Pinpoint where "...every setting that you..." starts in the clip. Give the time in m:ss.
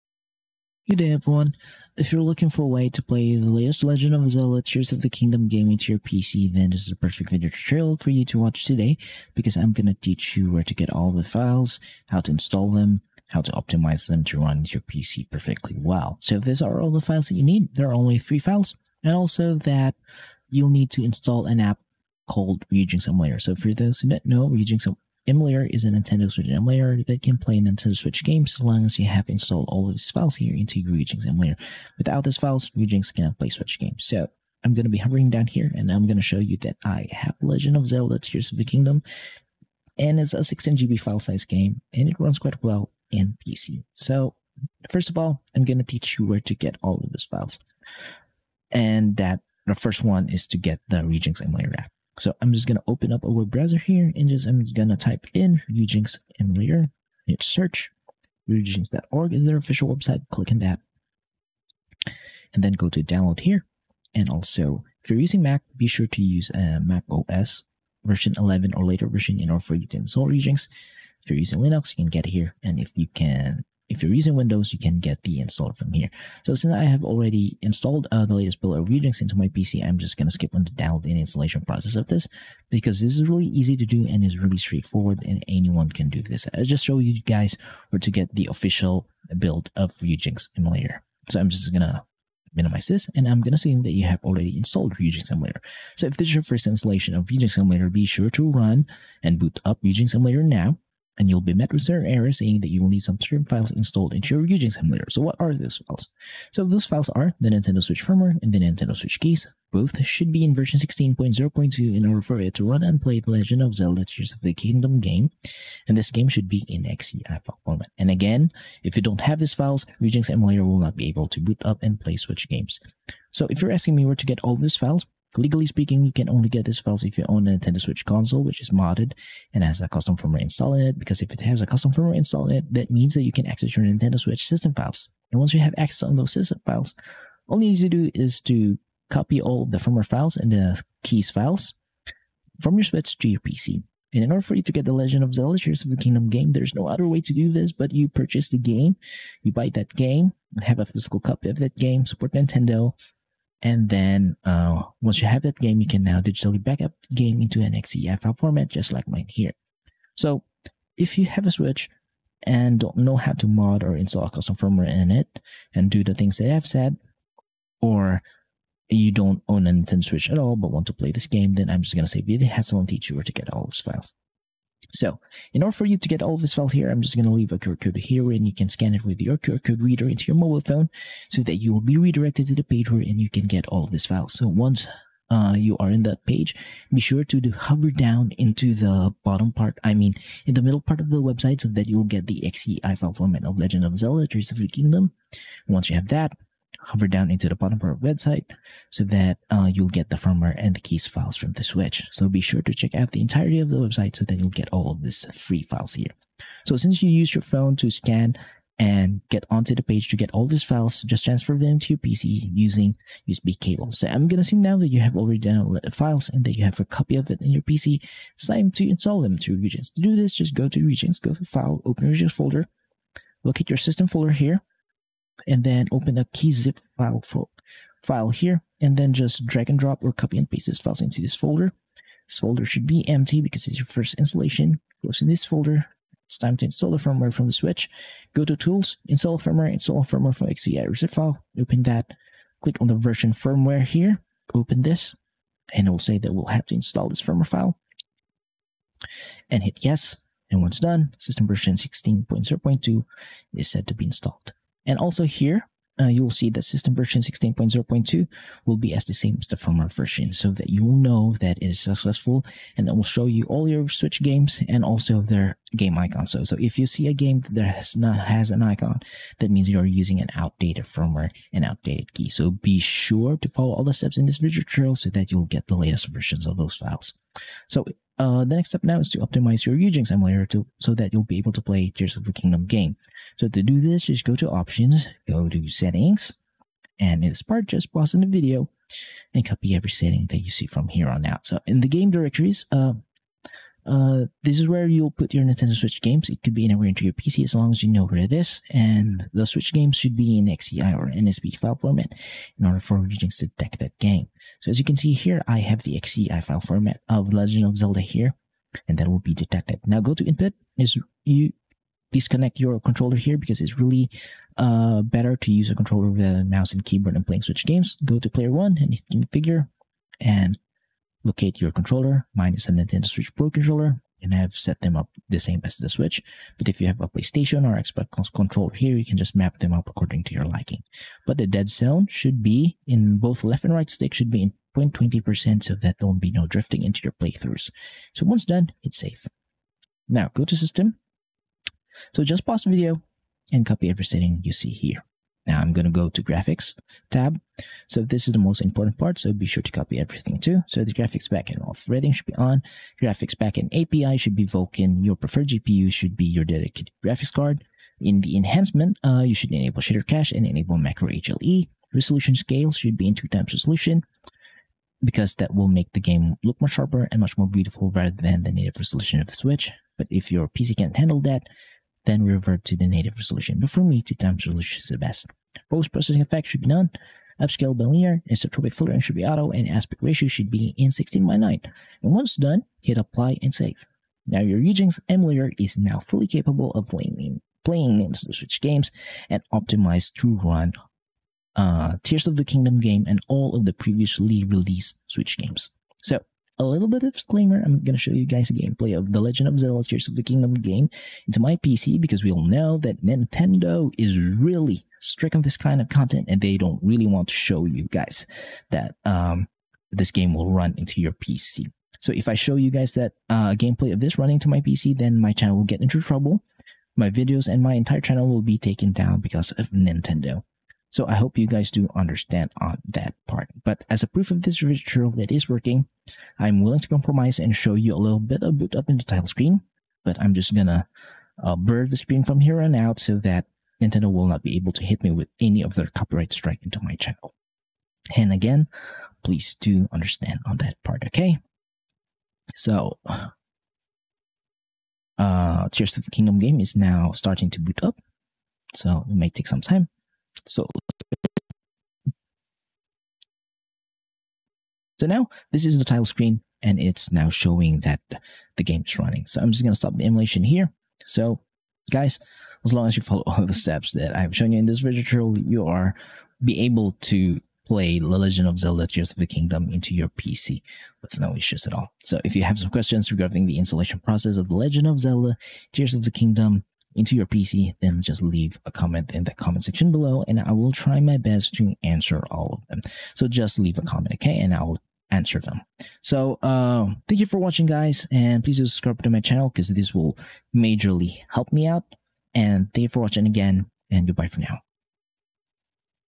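4:49.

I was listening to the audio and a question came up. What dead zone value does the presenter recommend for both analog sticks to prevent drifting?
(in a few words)
0.20%.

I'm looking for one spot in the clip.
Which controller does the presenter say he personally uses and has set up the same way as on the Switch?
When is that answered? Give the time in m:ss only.
5:22.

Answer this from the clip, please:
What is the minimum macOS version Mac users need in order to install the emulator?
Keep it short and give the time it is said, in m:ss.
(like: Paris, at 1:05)
11, at 1:08.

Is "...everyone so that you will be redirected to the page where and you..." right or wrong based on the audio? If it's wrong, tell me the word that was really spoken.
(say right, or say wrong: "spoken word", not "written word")
wrong: "phone", not "everyone".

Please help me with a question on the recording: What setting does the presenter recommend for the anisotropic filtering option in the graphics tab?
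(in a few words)
Auto.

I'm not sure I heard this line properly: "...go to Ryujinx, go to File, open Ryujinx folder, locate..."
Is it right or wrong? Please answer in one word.
right.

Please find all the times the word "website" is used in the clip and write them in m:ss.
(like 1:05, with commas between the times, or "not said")
0:59, 3:11, 3:18, 3:23.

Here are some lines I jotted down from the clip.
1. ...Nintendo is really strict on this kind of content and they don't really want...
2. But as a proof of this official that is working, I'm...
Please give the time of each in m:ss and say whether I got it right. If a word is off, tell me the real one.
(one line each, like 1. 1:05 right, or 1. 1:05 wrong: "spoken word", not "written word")
1. 6:43 right
2. 7:03 wrong: "ritual", not "official".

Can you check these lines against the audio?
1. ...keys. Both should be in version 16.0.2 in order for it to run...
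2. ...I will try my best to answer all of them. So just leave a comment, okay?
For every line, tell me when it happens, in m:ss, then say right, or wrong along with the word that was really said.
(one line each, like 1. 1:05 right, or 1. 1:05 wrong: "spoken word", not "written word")
1. 1:49 right
2. 8:00 right.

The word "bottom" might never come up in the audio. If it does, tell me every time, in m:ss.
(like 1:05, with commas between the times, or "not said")
3:09, 3:17.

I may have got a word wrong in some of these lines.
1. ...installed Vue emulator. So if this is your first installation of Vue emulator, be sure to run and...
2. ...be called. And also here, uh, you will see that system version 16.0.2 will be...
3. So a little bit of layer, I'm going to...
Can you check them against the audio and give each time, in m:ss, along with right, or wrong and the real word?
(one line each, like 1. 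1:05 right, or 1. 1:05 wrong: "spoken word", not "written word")
1. 1:34 right
2. 4:13 wrong: "installed", not "called"
3. 6:36 wrong: "disclaimer", not "layer".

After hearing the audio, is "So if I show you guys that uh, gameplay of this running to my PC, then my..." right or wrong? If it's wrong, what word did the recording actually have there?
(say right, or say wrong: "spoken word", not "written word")
right.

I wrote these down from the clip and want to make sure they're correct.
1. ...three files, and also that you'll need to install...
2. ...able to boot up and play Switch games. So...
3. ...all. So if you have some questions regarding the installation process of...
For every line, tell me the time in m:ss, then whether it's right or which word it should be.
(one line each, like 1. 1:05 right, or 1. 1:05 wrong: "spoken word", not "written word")
1. 0:18 right
2. 2:01 right
3. 7:51 right.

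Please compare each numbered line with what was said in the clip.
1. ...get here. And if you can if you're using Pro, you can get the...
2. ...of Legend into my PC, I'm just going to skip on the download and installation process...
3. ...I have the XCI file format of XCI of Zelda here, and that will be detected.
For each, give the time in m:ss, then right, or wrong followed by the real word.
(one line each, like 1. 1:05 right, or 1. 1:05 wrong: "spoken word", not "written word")
1. 1:12 wrong: "Windows", not "Pro"
2. 1:18 wrong: "Ryujinx", not "Legend"
3. 5:05 wrong: "Legend", not "XCI".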